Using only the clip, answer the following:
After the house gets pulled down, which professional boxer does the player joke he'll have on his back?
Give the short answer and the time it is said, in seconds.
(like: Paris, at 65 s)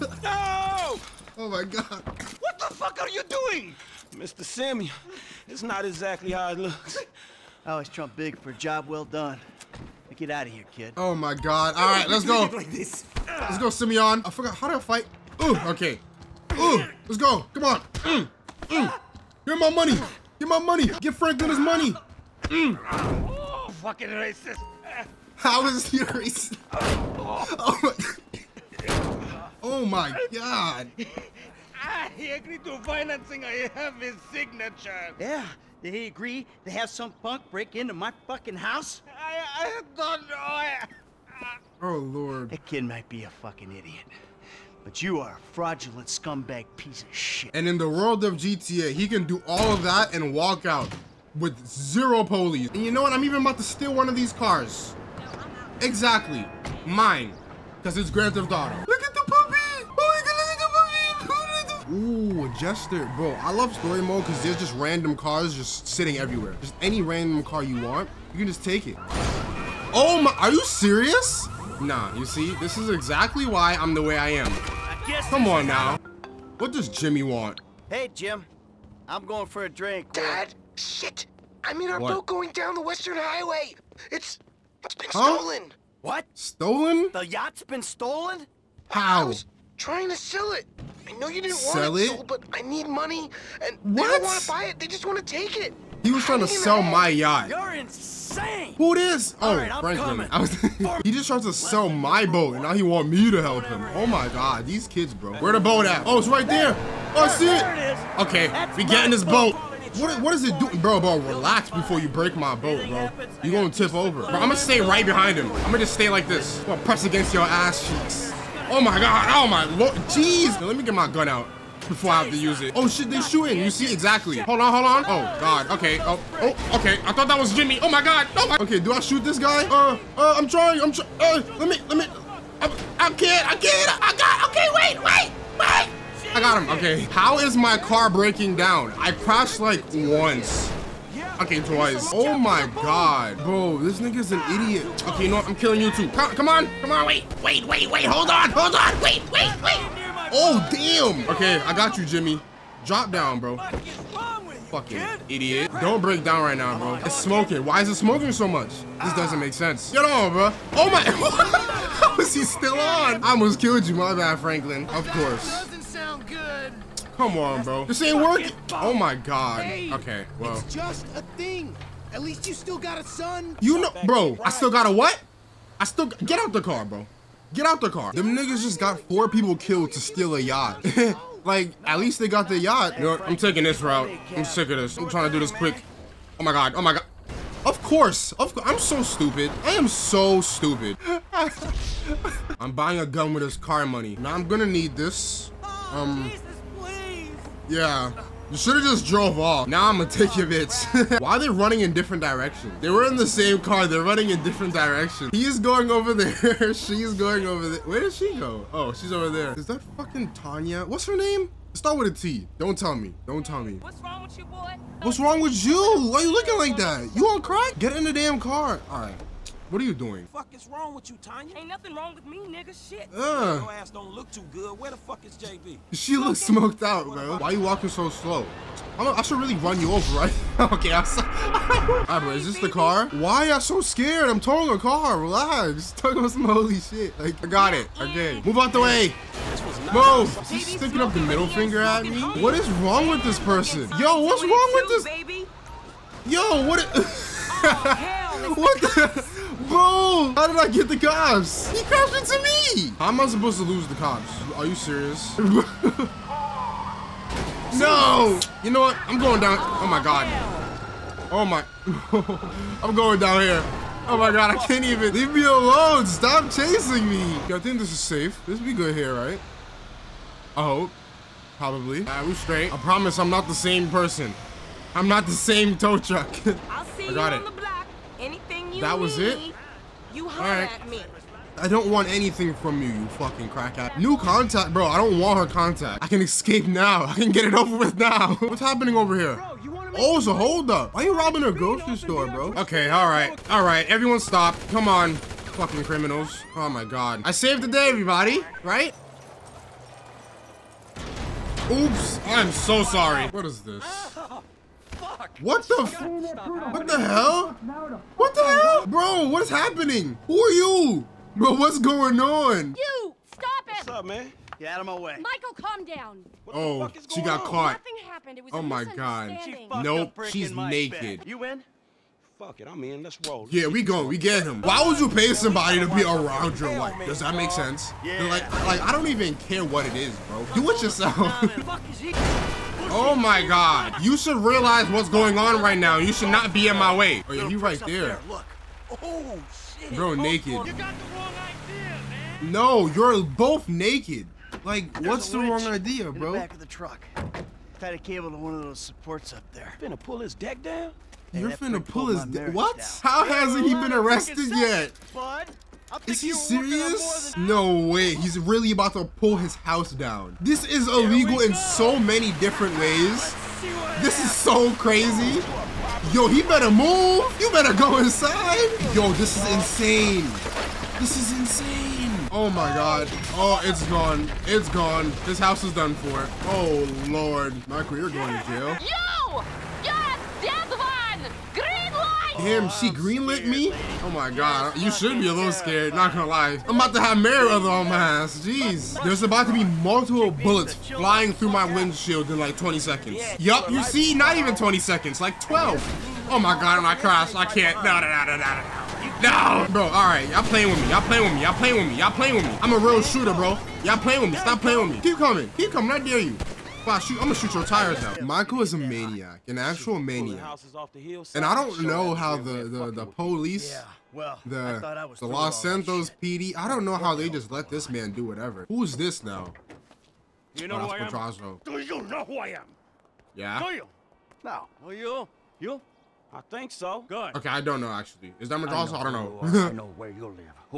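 Mayweather, at 387 s.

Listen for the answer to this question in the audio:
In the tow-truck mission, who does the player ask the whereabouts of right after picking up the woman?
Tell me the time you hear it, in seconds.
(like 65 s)
225 s.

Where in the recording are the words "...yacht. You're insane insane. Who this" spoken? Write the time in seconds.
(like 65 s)
97 s.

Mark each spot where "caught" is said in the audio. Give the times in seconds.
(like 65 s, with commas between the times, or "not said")
317 s.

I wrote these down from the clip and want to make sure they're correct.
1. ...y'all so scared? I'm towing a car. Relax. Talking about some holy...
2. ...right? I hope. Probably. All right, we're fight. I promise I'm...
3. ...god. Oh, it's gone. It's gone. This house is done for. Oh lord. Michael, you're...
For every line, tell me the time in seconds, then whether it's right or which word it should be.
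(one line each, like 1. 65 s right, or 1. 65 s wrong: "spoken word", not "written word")
1. 233 s right
2. 269 s wrong: "straight", not "fight"
3. 372 s right.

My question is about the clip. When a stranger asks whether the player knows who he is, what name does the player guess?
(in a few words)
Madrazo.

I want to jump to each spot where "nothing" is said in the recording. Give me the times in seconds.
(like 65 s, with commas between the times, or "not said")
221 s, 317 s.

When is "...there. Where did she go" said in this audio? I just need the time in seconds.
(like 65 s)
207 s.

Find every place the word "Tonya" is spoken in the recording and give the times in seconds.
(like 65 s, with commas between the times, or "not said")
210 s, 221 s.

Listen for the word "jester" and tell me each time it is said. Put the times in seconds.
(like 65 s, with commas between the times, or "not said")
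62 s.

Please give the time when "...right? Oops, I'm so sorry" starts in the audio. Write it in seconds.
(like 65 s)
298 s.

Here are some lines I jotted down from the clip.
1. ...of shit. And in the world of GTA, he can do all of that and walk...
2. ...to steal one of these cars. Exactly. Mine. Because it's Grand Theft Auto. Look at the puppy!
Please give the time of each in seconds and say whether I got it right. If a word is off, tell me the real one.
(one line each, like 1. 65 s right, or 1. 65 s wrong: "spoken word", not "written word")
1. 47 s right
2. 53 s right.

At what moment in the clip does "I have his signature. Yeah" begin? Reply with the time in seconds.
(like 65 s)
33 s.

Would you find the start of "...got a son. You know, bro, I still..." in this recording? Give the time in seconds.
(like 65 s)
172 s.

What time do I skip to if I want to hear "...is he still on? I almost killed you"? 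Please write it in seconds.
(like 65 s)
162 s.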